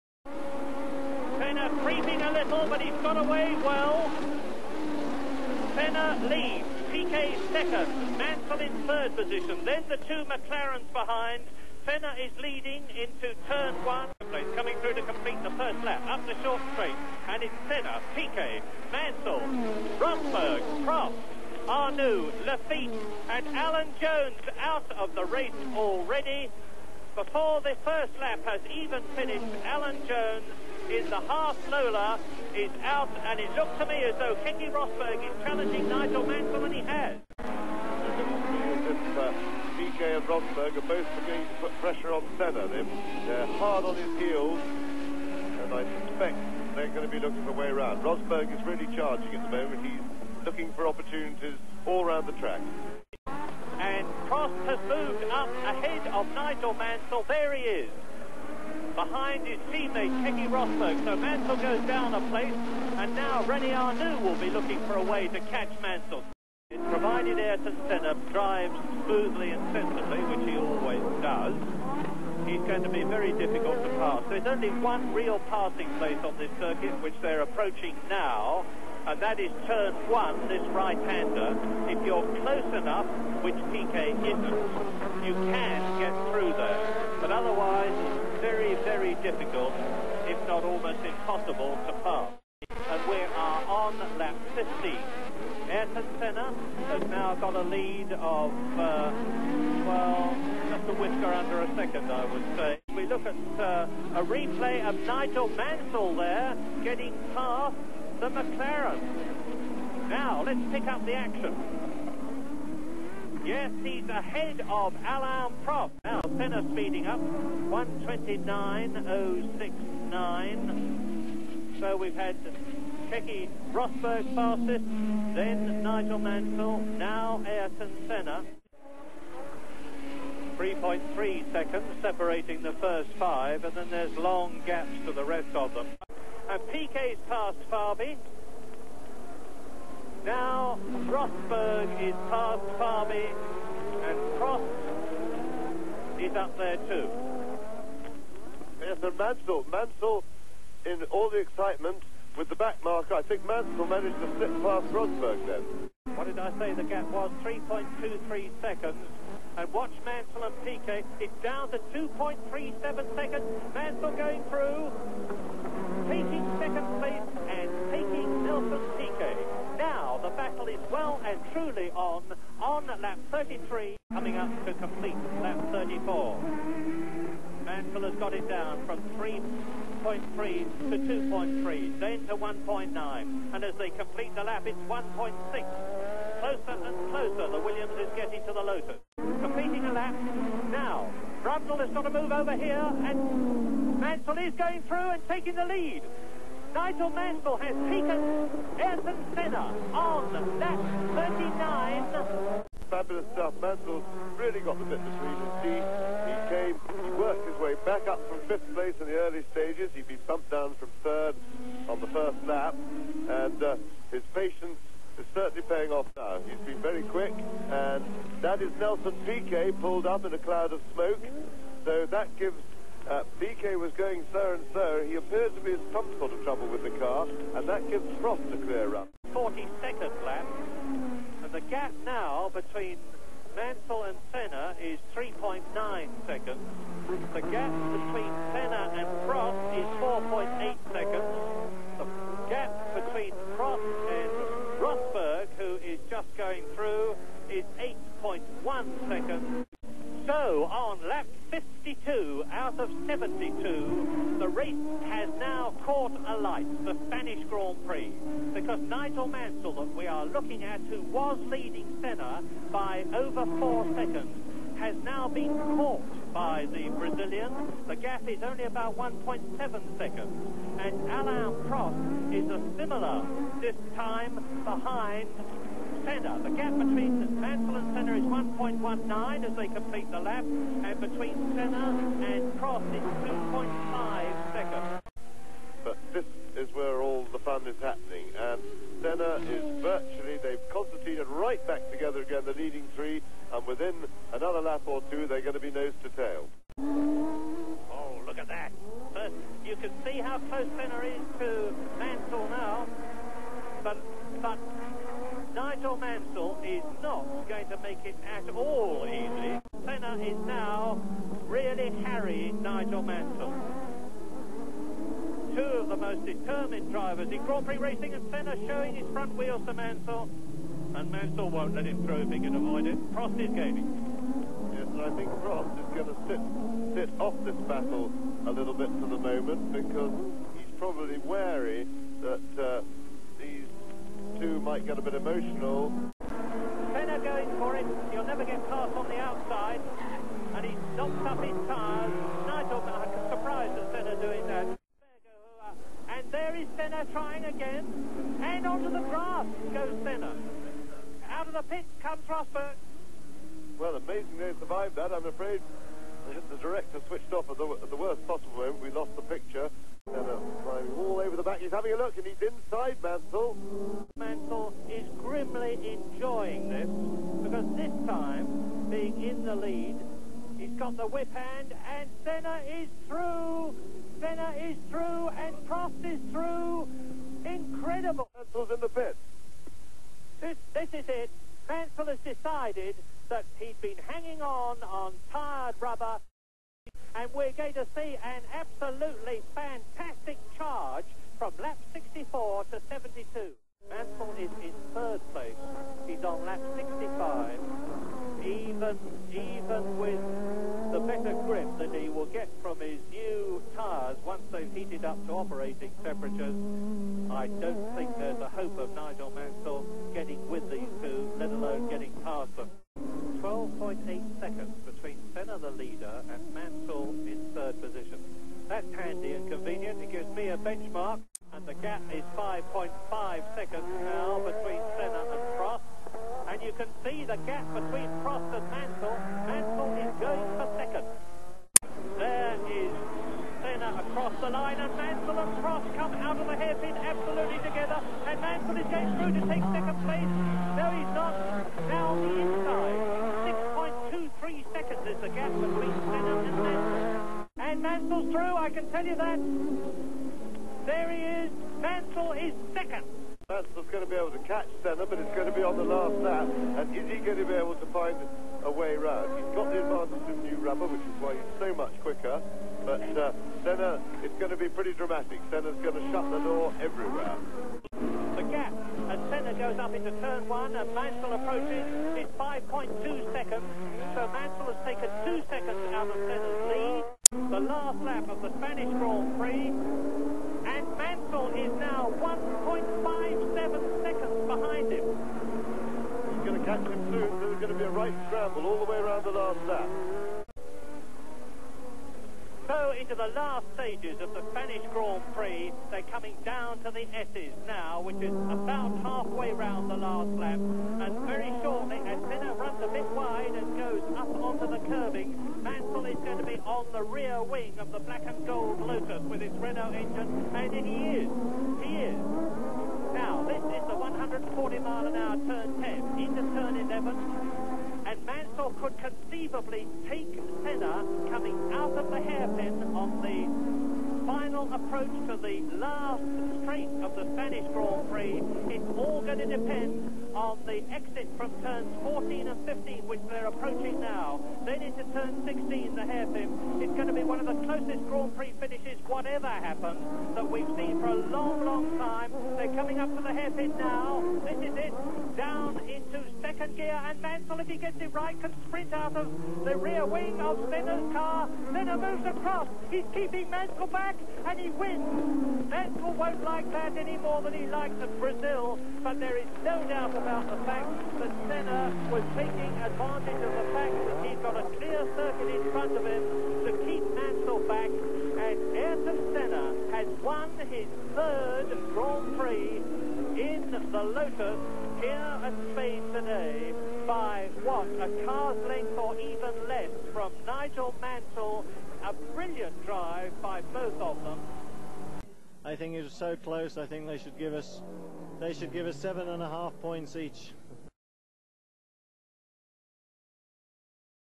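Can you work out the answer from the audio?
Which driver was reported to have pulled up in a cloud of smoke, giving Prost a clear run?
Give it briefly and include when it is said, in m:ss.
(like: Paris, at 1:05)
Nelson Piquet, at 3:38.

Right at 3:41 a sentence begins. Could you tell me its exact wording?
So that gives uh, Piquet was going so and so.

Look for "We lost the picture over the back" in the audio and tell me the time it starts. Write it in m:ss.
5:58.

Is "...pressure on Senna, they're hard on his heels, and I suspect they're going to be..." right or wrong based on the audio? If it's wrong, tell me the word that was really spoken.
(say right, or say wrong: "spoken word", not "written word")
right.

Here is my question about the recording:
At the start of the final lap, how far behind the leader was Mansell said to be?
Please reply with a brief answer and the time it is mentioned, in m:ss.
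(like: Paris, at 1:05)
1.57 seconds, at 8:02.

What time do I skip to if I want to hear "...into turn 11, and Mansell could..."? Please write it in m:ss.
8:36.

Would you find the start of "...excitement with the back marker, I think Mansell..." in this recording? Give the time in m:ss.
2:31.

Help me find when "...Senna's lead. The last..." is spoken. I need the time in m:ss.
7:56.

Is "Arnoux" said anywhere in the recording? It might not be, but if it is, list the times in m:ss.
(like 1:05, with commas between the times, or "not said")
0:21, 1:03.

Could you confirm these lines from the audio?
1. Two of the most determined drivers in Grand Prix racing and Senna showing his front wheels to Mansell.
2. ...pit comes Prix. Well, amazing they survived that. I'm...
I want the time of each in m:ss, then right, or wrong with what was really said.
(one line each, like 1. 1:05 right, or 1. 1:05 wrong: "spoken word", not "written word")
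1. 5:15 right
2. 5:51 wrong: "Rosberg", not "Prix".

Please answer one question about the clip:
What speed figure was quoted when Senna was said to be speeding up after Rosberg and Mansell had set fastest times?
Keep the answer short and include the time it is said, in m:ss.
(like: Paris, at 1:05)
129.069, at 1:57.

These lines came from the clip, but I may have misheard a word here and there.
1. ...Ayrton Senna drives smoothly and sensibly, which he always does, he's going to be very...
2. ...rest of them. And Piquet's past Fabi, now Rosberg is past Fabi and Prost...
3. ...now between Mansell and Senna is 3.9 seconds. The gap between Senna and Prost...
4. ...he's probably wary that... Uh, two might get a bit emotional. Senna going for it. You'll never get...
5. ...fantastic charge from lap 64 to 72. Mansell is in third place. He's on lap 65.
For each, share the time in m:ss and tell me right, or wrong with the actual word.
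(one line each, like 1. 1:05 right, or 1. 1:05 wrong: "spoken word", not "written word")
1. 1:07 right
2. 2:15 right
3. 3:52 right
4. 5:30 right
5. 6:29 right.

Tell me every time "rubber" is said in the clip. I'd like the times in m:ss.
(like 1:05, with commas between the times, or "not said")
6:25, 7:40.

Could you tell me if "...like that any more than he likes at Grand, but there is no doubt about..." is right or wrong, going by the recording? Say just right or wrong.
wrong.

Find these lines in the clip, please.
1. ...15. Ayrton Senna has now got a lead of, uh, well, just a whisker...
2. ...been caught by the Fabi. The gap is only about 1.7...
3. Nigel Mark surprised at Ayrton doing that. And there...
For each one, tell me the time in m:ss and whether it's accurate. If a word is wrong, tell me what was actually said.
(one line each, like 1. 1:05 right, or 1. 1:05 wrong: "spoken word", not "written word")
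1. 1:34 right
2. 4:25 wrong: "Brazilian", not "Fabi"
3. 5:42 wrong: "Senna", not "Ayrton".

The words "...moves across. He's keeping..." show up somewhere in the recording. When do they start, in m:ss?
9:11.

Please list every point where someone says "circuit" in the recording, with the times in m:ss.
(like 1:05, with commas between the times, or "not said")
1:16, 9:25.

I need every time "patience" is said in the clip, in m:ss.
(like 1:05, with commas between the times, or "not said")
3:34.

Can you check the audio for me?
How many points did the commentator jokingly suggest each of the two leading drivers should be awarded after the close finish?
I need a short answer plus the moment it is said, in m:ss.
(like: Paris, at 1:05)
7.5, at 9:48.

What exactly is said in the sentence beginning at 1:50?
Now, let's pick up the action.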